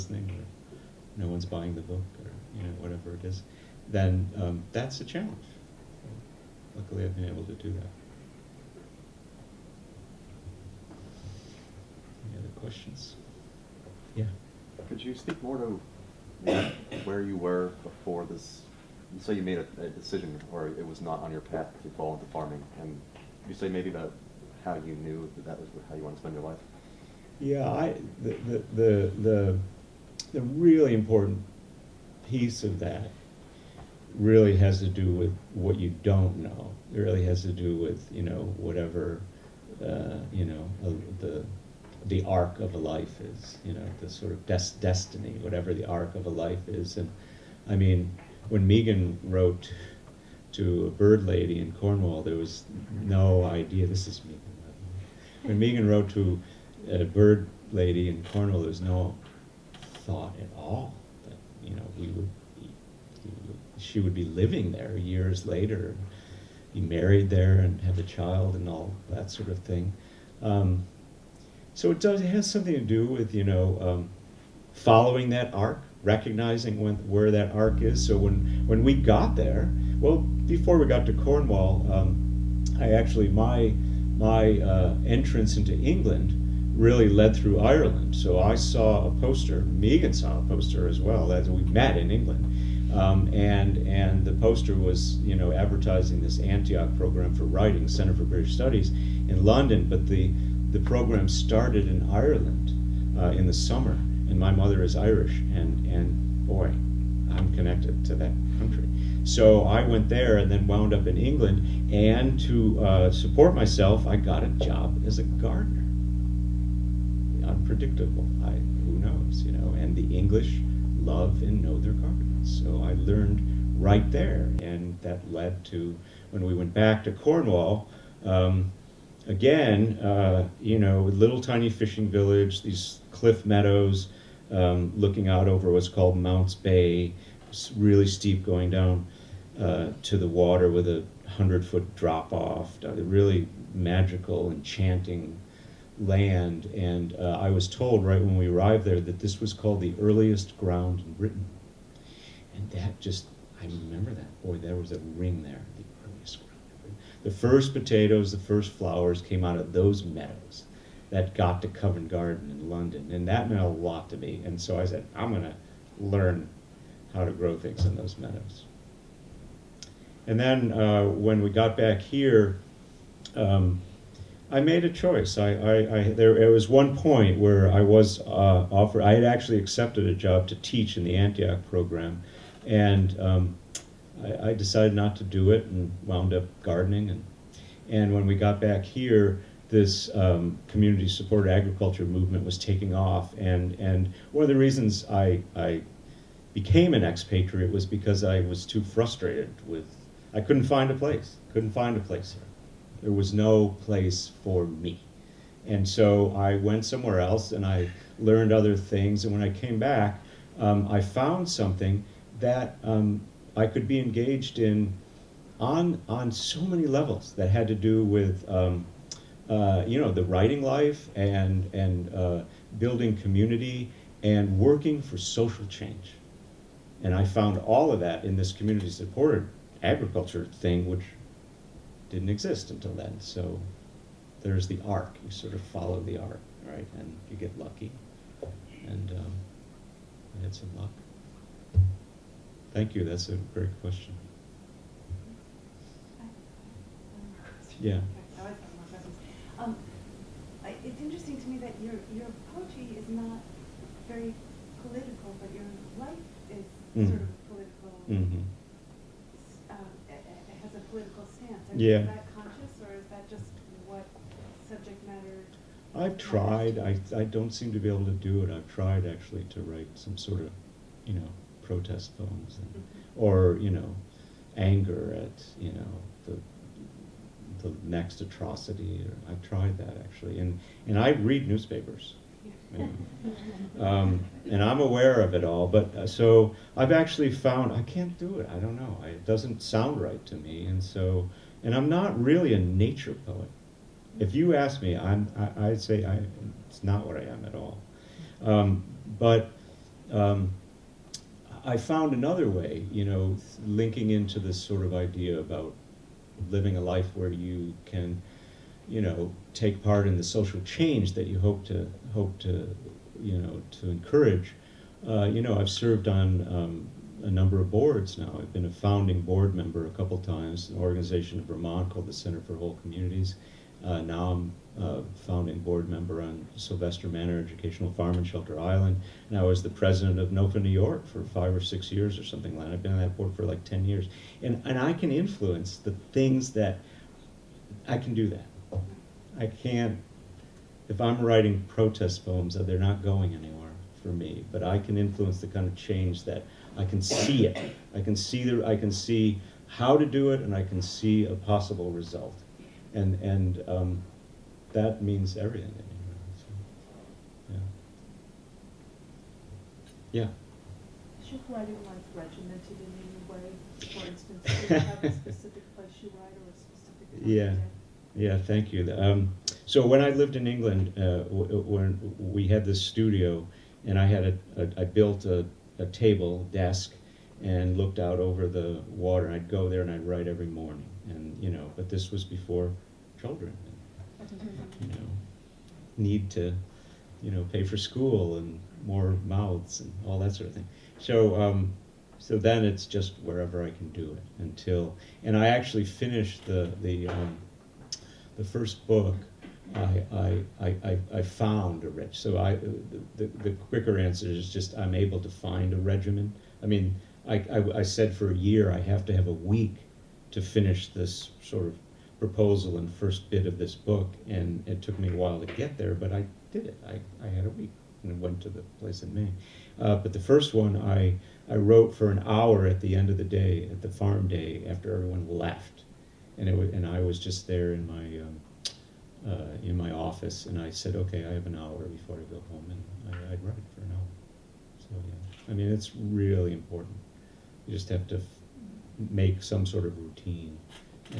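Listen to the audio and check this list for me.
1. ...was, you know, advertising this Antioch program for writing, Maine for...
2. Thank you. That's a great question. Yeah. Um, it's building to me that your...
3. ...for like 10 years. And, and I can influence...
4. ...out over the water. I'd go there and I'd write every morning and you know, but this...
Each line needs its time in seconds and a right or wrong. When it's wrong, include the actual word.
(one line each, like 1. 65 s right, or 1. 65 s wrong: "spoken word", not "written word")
1. 94 s wrong: "Center", not "Maine"
2. 242 s wrong: "interesting", not "building"
3. 333 s right
4. 377 s right.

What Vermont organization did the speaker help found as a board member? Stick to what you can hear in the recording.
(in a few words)
Center for Whole Communities.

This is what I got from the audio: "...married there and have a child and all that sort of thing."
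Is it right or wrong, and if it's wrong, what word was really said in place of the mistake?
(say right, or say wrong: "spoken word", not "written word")
right.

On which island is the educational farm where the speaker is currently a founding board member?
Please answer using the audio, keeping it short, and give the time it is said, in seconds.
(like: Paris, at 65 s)
Shelter Island, at 328 s.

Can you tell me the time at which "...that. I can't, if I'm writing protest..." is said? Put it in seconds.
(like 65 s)
338 s.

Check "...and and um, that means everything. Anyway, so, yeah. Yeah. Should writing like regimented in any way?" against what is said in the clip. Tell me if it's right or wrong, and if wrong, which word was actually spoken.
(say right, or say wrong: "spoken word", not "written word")
right.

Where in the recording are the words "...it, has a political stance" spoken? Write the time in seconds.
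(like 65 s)
260 s.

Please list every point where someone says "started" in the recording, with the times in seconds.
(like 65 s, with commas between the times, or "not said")
101 s.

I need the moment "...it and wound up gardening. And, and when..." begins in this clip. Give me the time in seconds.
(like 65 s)
185 s.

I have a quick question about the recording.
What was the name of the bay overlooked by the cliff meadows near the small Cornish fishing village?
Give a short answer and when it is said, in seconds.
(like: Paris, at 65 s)
Mounts Bay, at 136 s.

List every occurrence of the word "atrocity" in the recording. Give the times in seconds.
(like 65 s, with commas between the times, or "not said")
278 s.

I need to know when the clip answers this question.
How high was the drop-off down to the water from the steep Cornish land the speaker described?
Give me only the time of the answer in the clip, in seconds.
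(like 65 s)
141 s.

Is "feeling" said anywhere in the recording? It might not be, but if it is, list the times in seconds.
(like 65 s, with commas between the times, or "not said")
not said.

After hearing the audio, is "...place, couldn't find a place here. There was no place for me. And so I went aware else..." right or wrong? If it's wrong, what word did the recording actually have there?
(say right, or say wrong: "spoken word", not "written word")
wrong: "somewhere", not "aware".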